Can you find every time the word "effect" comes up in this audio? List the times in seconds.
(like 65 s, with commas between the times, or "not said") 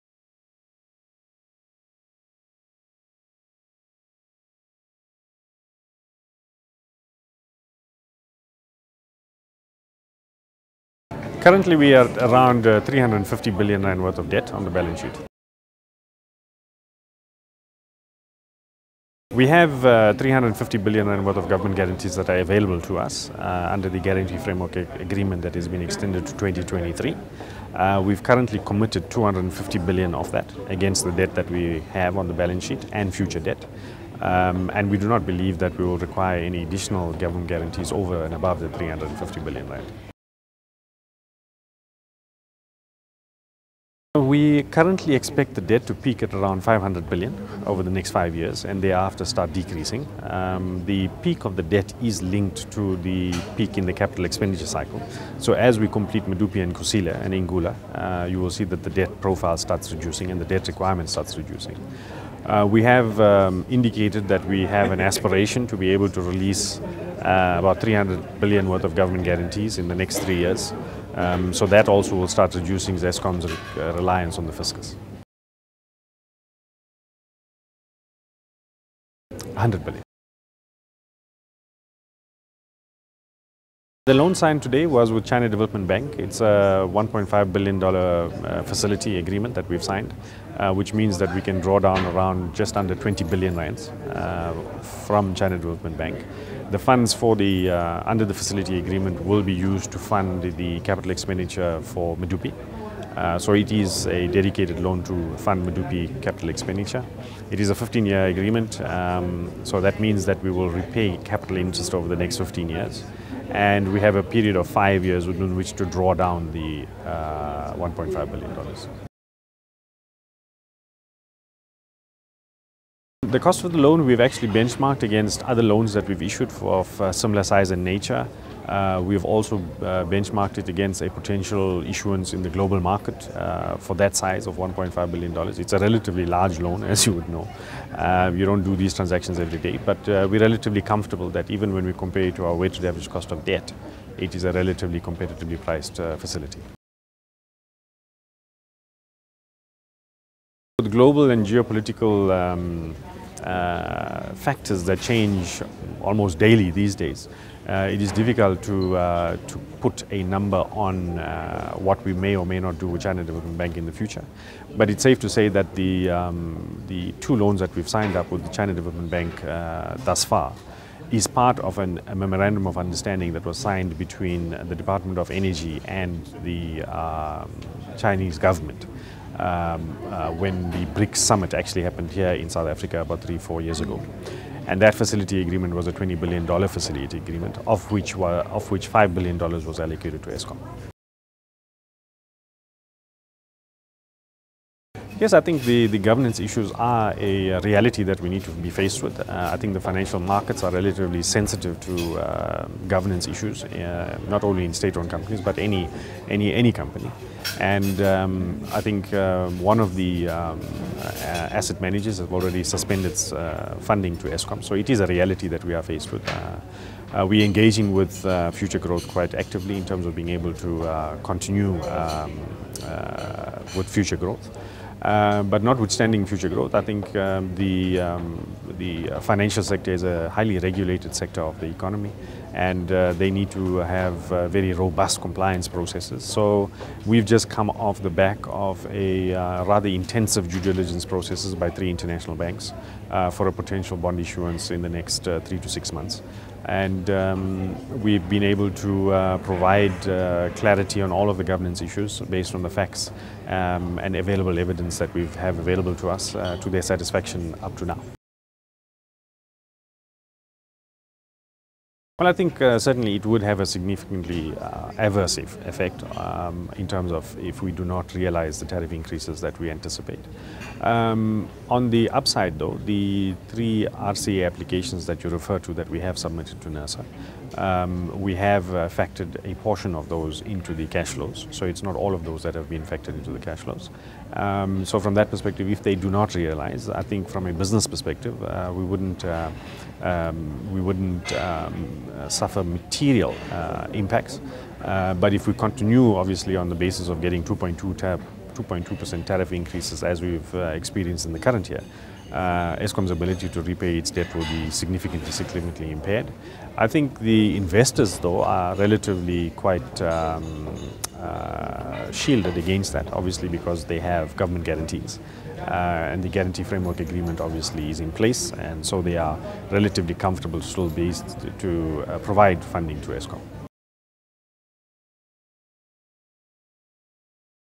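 265 s.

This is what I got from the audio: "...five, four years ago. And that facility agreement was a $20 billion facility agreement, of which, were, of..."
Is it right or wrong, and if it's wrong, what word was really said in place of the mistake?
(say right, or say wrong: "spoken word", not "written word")
wrong: "three", not "five".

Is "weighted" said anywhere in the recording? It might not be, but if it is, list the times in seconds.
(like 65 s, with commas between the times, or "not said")
142 s.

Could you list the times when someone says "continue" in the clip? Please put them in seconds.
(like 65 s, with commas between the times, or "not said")
221 s, 295 s.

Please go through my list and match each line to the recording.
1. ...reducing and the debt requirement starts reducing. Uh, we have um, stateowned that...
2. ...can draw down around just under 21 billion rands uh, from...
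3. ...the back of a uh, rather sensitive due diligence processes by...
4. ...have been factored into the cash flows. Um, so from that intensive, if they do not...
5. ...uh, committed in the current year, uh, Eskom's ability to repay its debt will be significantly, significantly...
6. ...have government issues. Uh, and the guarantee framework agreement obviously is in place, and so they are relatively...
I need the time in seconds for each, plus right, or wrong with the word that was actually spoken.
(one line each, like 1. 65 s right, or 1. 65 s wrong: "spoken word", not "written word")
1. 59 s wrong: "indicated", not "stateowned"
2. 91 s wrong: "20", not "21"
3. 238 s wrong: "intensive", not "sensitive"
4. 282 s wrong: "perspective", not "intensive"
5. 300 s wrong: "experienced", not "committed"
6. 313 s wrong: "guarantees", not "issues".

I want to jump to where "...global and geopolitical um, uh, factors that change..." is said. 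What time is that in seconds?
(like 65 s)
150 s.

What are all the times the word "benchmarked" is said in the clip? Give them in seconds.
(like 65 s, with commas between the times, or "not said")
124 s, 130 s.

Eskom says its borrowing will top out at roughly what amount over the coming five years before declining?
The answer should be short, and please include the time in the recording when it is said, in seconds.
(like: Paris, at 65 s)
500 billion rand, at 46 s.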